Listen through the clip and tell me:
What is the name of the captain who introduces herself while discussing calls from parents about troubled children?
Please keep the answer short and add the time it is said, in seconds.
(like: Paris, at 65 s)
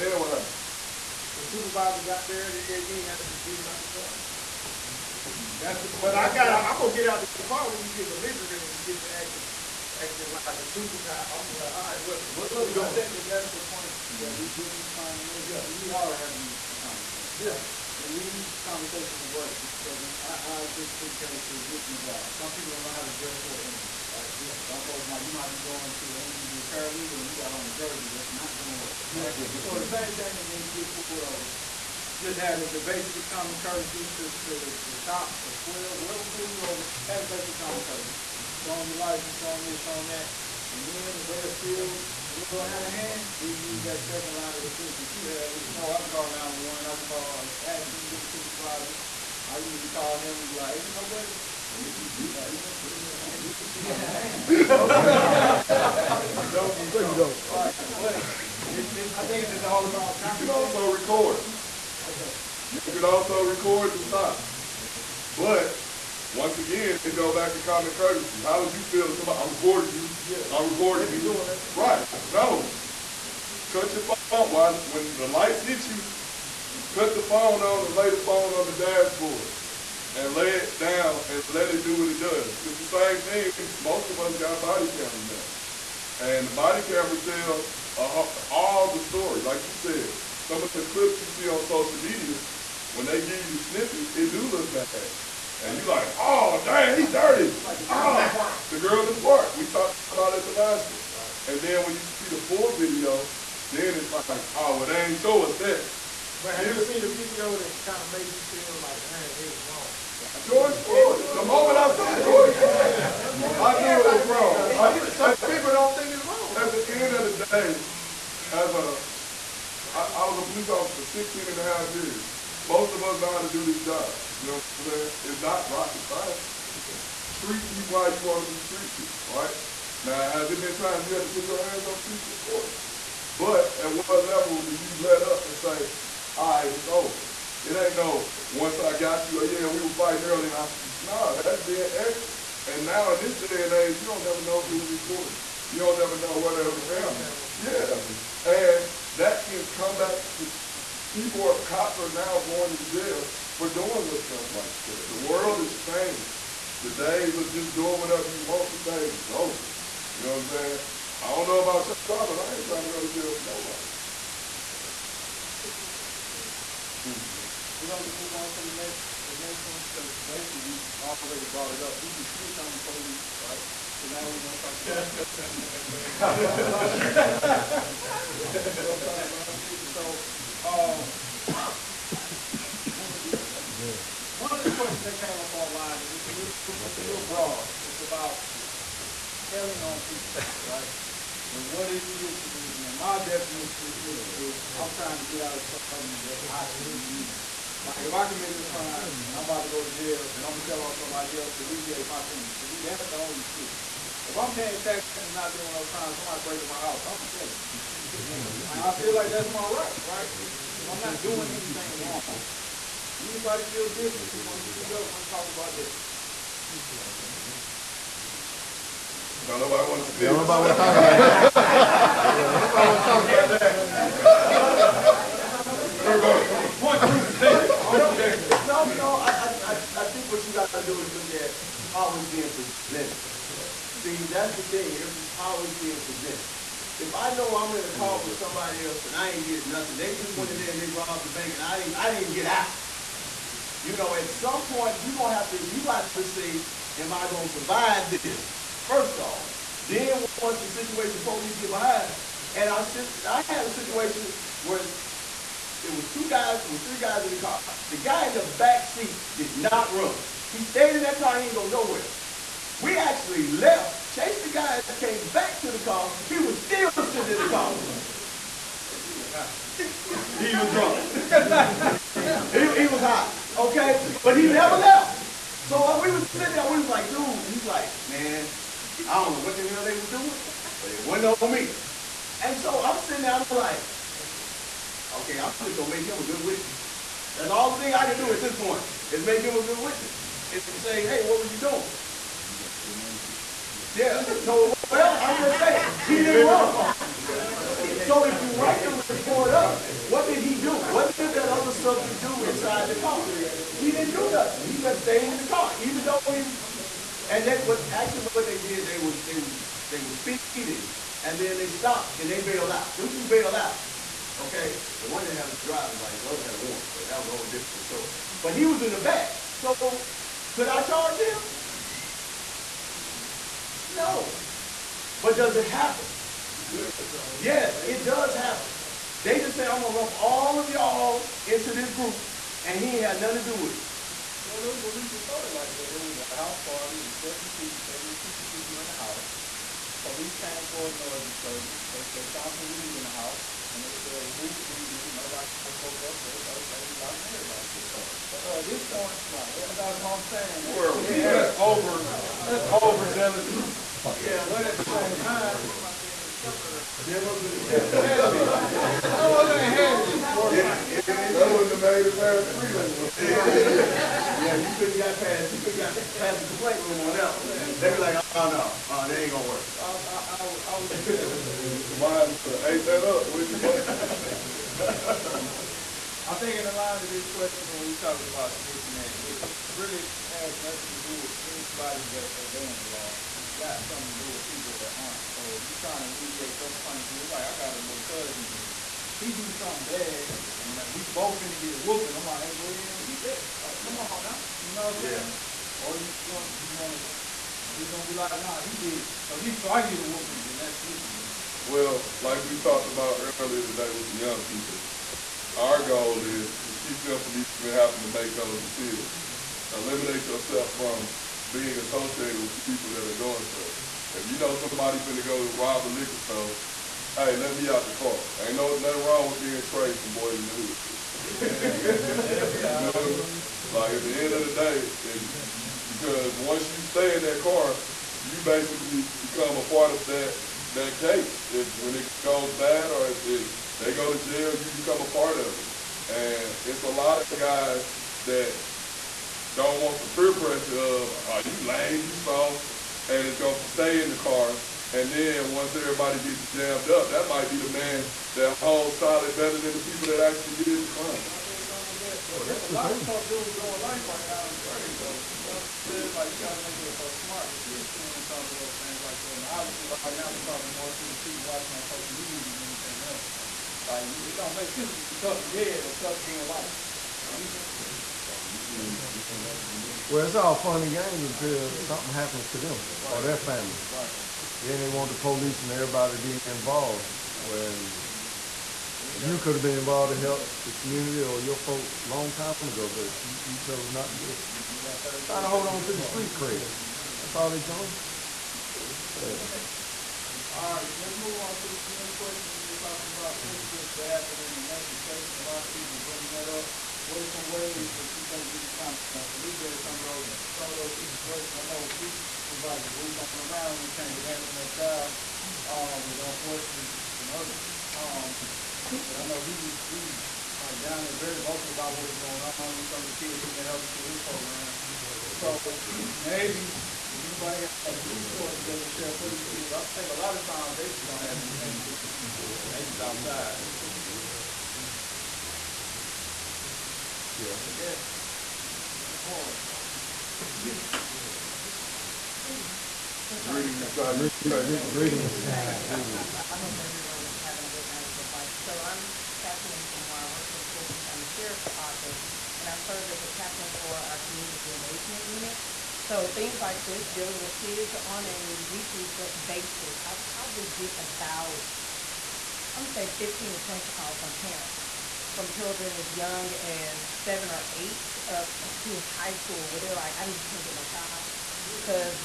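April Moore, at 539 s.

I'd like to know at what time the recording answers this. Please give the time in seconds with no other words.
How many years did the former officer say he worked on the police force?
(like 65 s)
121 s.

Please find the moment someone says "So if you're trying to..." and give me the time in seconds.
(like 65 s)
385 s.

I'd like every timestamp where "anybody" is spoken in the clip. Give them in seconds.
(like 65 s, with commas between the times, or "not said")
213 s, 381 s, 517 s.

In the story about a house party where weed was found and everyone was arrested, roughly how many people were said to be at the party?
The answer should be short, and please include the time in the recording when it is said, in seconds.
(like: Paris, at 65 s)
72, at 337 s.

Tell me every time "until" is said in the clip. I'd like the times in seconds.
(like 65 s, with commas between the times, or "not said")
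471 s.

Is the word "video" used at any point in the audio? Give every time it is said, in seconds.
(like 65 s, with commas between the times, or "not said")
102 s, 107 s.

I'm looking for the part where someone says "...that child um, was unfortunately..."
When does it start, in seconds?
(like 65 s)
504 s.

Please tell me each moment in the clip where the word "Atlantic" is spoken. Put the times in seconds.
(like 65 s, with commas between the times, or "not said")
494 s.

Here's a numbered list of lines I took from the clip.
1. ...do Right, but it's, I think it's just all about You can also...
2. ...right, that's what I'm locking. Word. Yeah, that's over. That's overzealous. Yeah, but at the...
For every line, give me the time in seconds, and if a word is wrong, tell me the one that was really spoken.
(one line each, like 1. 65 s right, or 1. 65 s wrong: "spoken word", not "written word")
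1. 57 s right
2. 349 s wrong: "saying", not "locking".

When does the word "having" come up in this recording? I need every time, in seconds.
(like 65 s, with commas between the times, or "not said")
407 s, 537 s.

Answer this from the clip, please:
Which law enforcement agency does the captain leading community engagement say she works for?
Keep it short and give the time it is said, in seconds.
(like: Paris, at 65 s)
Fulton County Sheriff's Office, at 540 s.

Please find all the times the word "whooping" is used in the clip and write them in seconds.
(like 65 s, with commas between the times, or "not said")
391 s, 400 s.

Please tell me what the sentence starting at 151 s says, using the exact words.
People are, cops are now going to jail for doing the stuff like that.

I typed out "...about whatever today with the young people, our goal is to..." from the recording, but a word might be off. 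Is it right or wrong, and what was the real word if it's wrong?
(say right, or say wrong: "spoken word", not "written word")
wrong: "earlier", not "whatever".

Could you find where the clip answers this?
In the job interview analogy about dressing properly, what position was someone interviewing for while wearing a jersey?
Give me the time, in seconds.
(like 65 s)
26 s.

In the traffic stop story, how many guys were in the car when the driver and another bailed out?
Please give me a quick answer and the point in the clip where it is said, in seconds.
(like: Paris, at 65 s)
3, at 256 s.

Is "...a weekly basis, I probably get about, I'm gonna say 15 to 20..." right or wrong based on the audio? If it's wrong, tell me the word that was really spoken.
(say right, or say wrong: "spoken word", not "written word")
right.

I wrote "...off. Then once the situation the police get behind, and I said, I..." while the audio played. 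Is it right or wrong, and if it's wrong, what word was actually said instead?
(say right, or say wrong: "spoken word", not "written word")
right.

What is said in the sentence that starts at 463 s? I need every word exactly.
Like, it don't make sense to be tough and dead or tough doing life.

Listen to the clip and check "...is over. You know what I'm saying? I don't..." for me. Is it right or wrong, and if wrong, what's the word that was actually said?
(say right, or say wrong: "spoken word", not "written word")
right.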